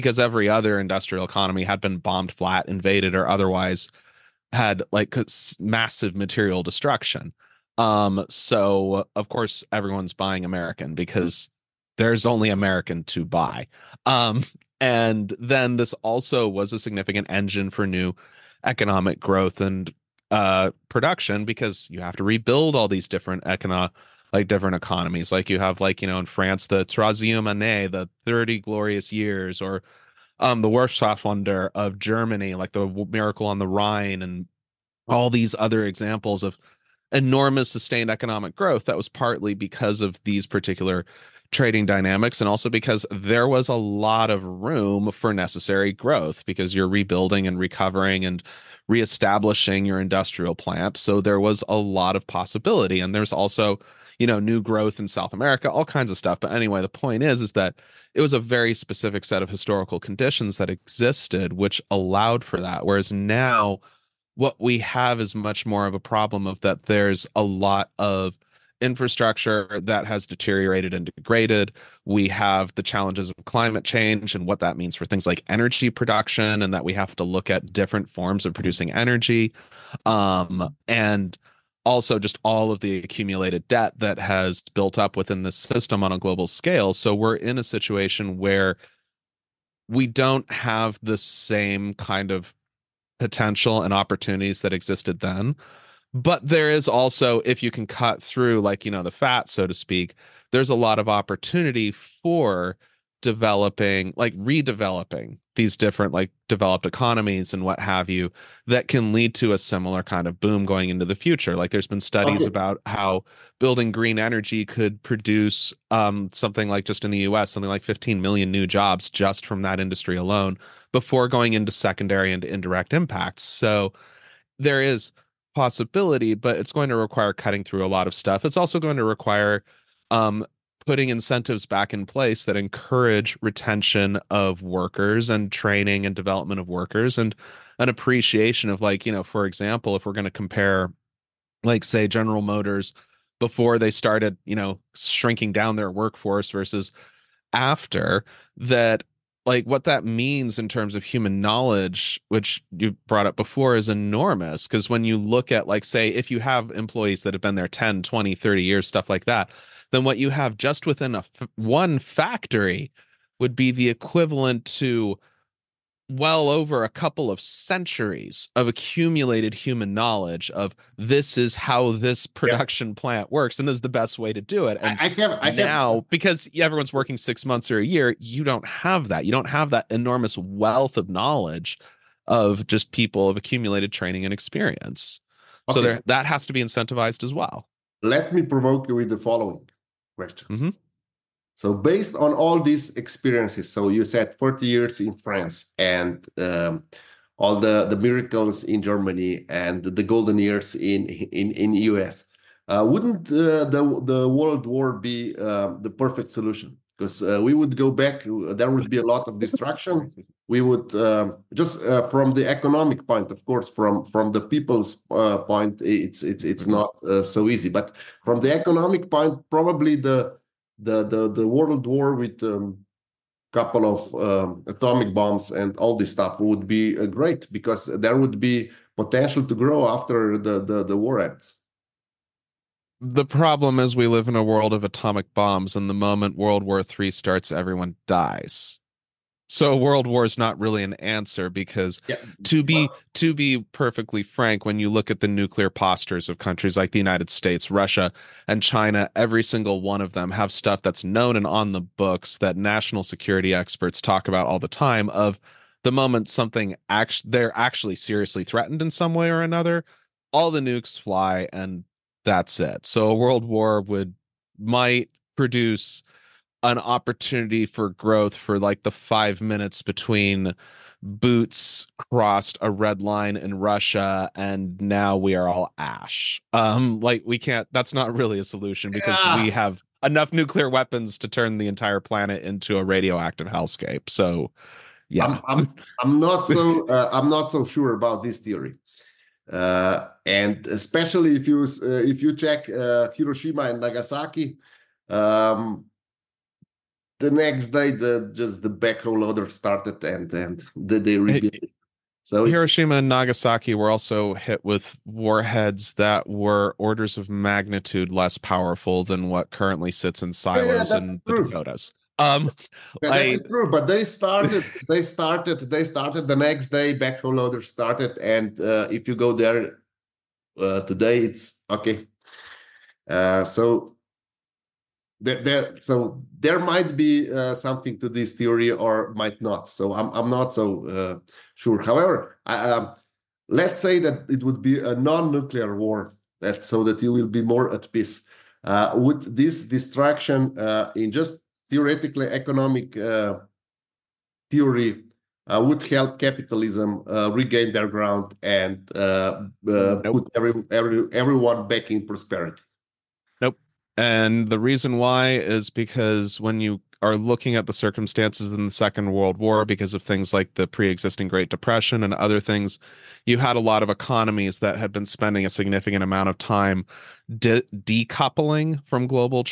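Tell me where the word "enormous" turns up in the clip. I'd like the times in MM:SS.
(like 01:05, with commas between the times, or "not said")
00:37, 02:33, 02:59.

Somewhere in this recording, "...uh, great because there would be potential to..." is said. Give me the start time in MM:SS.
03:46.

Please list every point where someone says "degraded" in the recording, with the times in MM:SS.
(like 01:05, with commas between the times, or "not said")
01:11.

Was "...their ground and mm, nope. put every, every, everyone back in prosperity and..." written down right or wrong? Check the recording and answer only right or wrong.
right.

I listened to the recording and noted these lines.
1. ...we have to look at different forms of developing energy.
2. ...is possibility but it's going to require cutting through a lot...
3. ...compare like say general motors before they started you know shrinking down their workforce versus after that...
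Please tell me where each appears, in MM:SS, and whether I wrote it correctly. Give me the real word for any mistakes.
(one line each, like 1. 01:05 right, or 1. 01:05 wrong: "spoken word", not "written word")
1. 01:16 wrong: "producing", not "developing"
2. 02:04 right
3. 02:20 right.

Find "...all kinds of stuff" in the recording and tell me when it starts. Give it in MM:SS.
00:55.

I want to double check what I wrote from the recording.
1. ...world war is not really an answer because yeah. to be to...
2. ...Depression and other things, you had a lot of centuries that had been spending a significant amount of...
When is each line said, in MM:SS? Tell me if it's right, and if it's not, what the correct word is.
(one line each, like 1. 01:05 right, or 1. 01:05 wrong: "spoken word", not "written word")
1. 03:59 right
2. 06:01 wrong: "economies", not "centuries".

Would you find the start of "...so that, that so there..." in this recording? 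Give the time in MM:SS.
05:23.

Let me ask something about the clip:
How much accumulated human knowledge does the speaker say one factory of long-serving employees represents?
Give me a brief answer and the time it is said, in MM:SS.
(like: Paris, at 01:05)
a couple of centuries, at 02:46.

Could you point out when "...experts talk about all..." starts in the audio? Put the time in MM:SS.
04:13.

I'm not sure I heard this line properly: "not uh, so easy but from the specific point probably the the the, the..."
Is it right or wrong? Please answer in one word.
wrong.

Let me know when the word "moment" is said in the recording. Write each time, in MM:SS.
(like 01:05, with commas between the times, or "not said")
03:55, 04:15.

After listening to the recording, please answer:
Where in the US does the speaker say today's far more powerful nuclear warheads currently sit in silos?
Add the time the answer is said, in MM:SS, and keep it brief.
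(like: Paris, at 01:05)
the Dakotas, at 05:11.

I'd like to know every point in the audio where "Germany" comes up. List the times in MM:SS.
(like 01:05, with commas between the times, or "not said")
00:31, 03:18.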